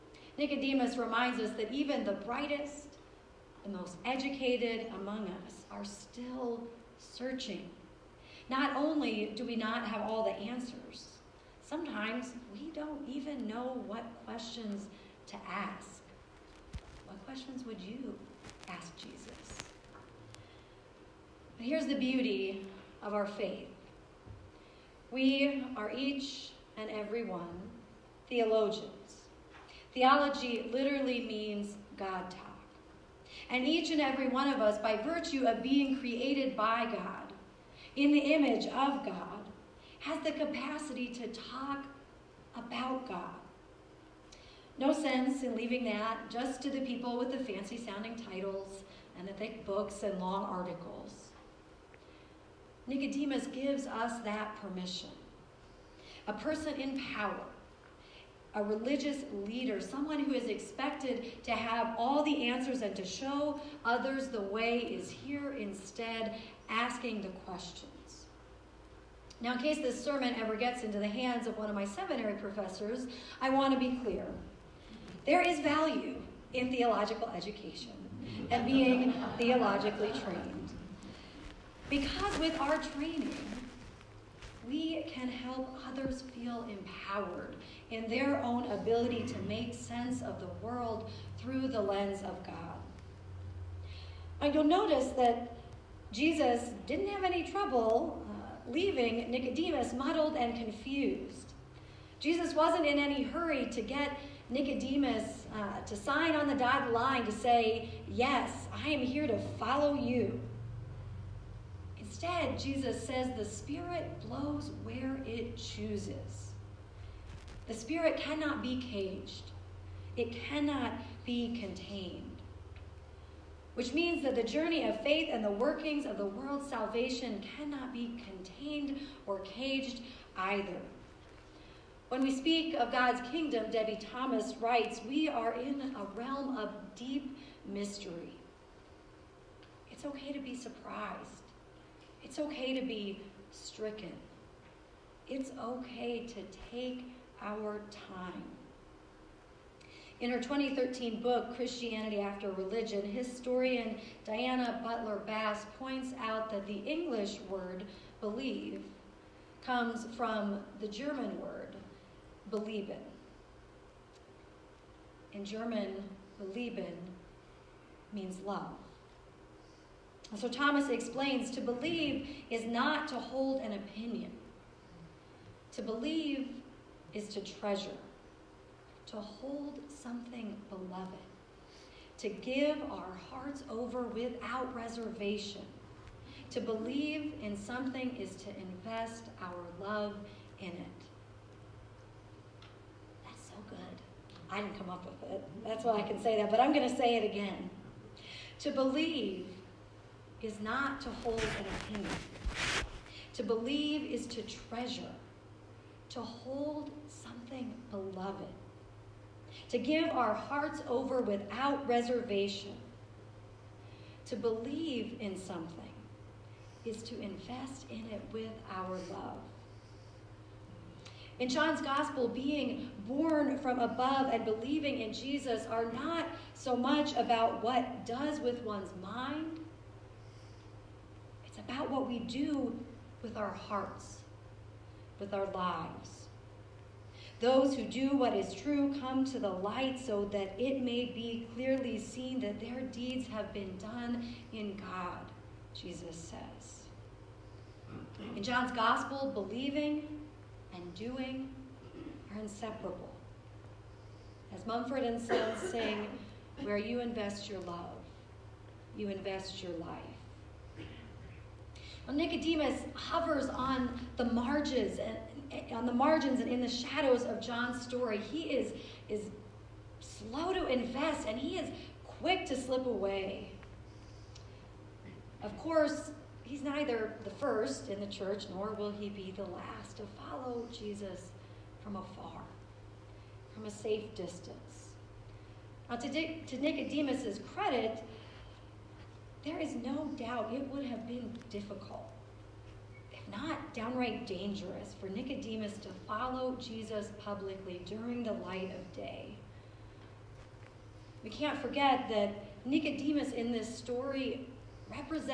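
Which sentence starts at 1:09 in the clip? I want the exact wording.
Now, in case this sermon ever gets into the hands of one of my seminary professors, I want to be clear.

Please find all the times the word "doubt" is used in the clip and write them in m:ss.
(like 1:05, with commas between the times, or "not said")
4:50.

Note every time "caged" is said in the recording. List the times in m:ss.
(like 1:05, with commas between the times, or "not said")
1:58, 2:09.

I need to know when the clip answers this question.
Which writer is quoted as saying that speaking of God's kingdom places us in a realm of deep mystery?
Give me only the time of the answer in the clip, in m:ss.
2:13.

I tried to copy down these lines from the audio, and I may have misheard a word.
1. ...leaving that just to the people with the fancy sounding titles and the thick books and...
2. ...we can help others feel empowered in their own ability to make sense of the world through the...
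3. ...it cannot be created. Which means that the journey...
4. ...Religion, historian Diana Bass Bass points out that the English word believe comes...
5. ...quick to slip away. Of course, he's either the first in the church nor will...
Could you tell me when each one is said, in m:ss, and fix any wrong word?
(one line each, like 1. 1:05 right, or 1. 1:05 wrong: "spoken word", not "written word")
1. 0:45 right
2. 1:24 right
3. 2:00 wrong: "contained", not "created"
4. 2:32 wrong: "Butler", not "Bass"
5. 4:32 wrong: "neither", not "either".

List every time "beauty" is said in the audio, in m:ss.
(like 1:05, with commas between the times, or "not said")
0:21.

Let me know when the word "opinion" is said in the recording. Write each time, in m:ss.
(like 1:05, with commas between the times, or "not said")
2:53, 3:21.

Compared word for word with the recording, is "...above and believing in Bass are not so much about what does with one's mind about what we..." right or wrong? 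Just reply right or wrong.
wrong.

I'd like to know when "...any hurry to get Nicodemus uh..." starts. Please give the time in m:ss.
1:42.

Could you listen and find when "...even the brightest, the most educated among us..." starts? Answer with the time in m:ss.
0:01.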